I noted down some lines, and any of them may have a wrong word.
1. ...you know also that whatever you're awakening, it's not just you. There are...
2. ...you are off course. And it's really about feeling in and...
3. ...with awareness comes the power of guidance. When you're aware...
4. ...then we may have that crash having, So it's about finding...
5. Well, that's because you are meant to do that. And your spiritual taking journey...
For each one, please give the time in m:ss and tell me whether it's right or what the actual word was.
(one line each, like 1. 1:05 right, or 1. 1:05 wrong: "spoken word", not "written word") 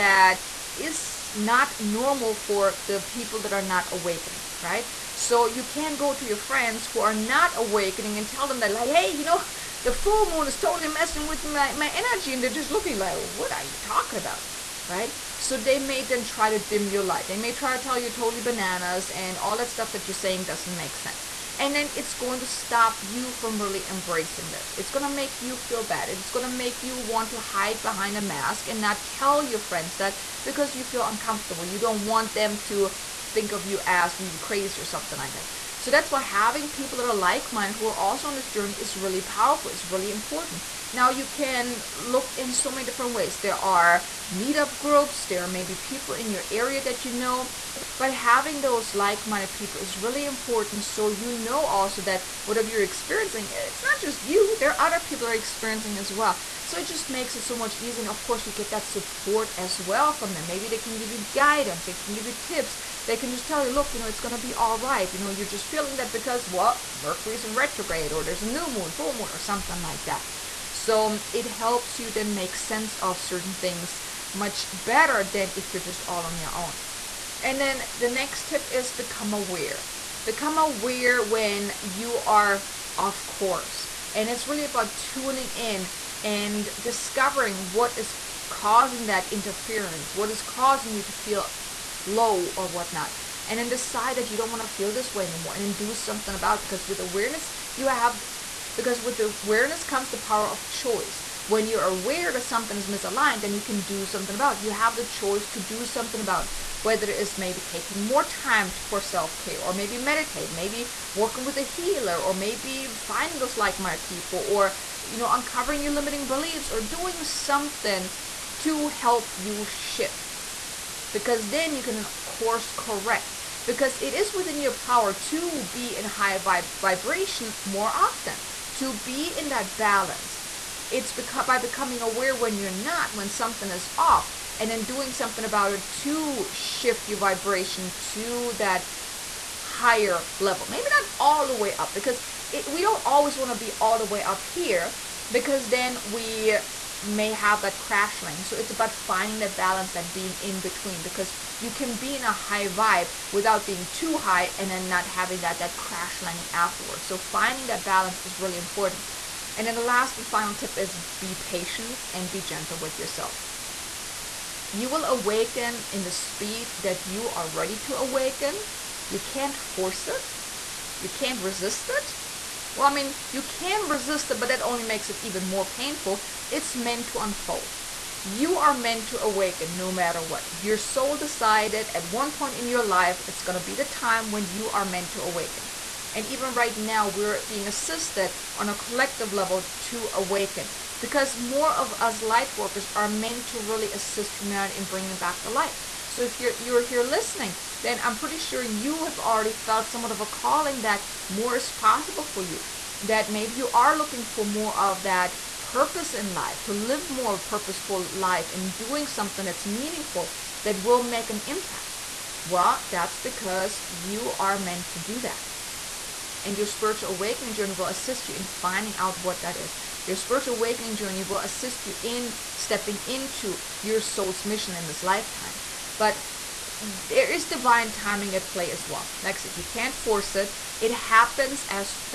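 1. 0:51 wrong: "experiencing", not "awakening"
2. 1:21 wrong: "tuning", not "feeling"
3. 1:38 wrong: "choice", not "guidance"
4. 2:25 wrong: "landing", not "having"
5. 3:32 wrong: "awakening", not "taking".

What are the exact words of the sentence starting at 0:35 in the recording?
So that's why having people that are like-minded who are also on this journey is really powerful.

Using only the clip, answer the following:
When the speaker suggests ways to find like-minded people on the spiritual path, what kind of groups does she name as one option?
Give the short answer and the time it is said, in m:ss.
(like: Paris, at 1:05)
Meetup groups, at 0:44.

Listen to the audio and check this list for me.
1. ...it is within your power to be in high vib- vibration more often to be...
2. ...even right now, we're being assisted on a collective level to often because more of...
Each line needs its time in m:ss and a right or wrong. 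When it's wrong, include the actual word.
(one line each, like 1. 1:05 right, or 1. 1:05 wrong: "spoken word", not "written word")
1. 2:03 right
2. 3:06 wrong: "awaken", not "often".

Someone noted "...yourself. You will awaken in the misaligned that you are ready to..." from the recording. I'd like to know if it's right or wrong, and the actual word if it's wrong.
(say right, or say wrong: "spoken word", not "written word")
wrong: "speed", not "misaligned".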